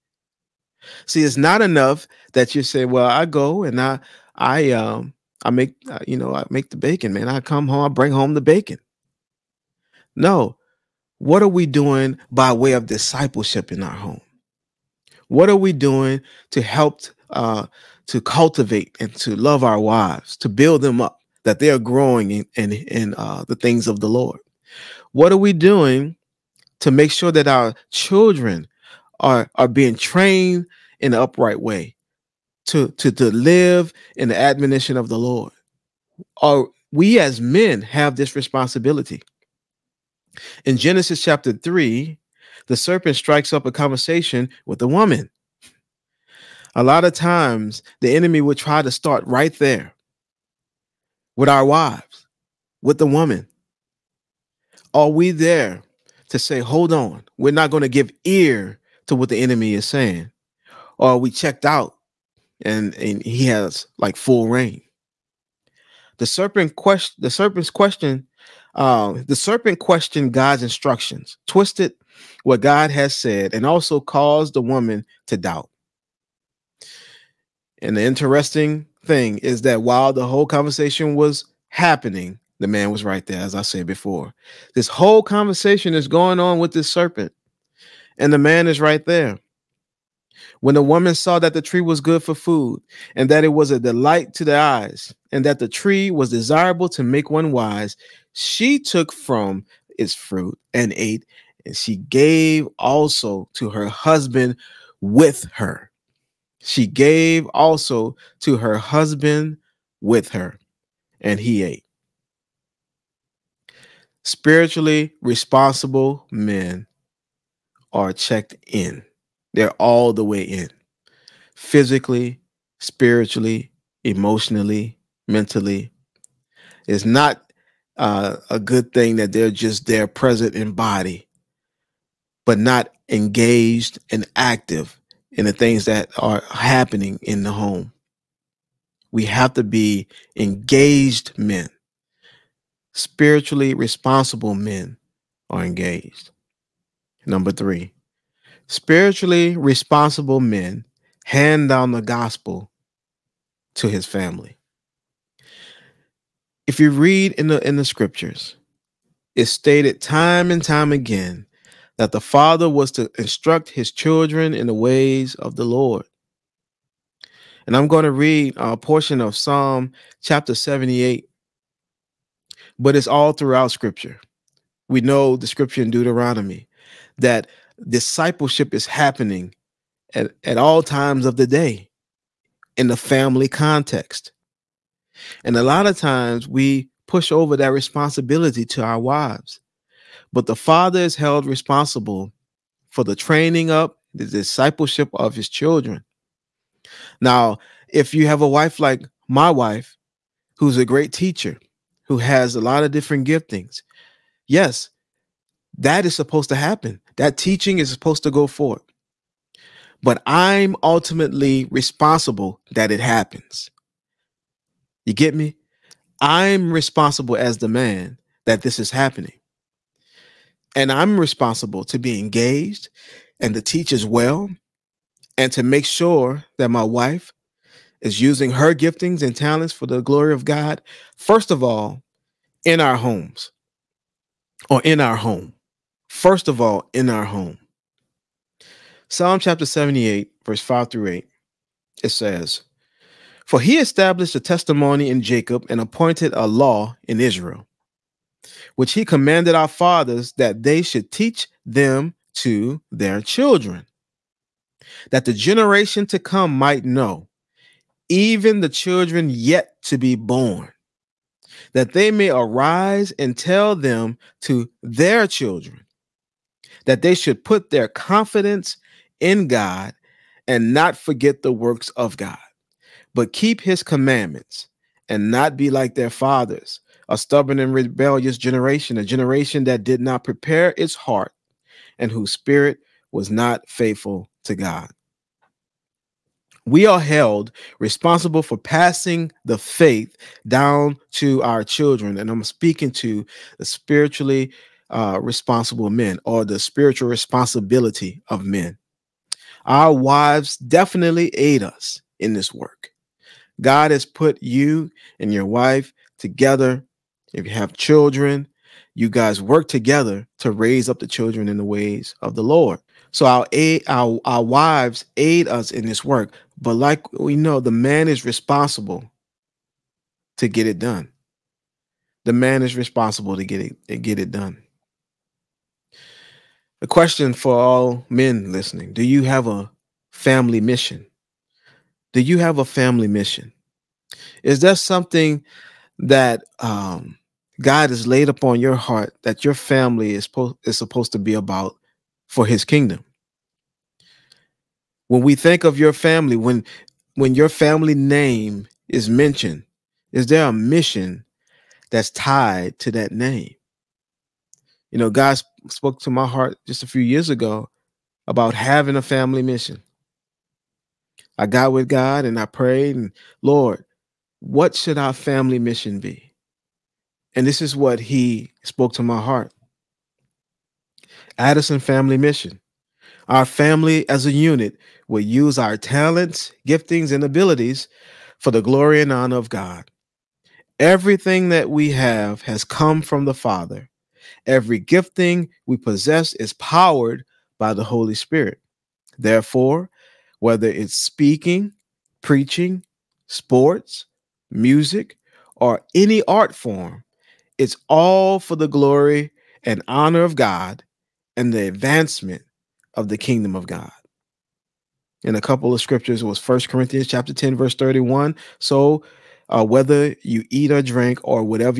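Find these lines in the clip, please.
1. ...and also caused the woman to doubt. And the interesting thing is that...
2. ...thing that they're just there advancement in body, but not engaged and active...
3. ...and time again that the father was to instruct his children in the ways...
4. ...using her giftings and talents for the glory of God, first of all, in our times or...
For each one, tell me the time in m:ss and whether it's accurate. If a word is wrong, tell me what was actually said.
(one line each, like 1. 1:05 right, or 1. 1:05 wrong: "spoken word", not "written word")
1. 1:13 right
2. 2:08 wrong: "present", not "advancement"
3. 2:40 right
4. 3:48 wrong: "homes", not "times".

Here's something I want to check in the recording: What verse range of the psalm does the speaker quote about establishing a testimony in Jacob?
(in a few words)
5 through 8.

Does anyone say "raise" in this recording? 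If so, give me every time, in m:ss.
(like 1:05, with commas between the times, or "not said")
5:10.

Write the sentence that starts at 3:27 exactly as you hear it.
That teaching is supposed to go forward.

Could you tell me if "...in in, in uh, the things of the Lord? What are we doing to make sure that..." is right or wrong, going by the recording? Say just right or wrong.
right.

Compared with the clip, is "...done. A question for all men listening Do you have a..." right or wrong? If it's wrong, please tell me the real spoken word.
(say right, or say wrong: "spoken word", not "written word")
right.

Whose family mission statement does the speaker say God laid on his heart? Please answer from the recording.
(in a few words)
Addison.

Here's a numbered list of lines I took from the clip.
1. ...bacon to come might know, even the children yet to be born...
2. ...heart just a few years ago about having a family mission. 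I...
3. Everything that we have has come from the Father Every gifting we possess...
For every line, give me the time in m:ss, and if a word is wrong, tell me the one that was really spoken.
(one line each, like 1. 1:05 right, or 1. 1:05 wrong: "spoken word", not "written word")
1. 4:15 wrong: "generation", not "bacon"
2. 5:56 right
3. 6:20 right.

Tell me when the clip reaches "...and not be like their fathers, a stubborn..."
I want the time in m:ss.
4:35.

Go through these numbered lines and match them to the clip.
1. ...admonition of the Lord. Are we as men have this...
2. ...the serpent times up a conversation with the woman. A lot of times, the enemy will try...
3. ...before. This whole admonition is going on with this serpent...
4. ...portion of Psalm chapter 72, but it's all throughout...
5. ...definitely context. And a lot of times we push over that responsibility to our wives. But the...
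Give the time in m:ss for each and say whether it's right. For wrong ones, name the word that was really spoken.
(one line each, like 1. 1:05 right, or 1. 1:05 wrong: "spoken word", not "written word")
1. 0:34 right
2. 0:42 wrong: "strikes", not "times"
3. 1:23 wrong: "conversation", not "admonition"
4. 2:48 wrong: "78", not "72"
5. 3:02 wrong: "family", not "definitely".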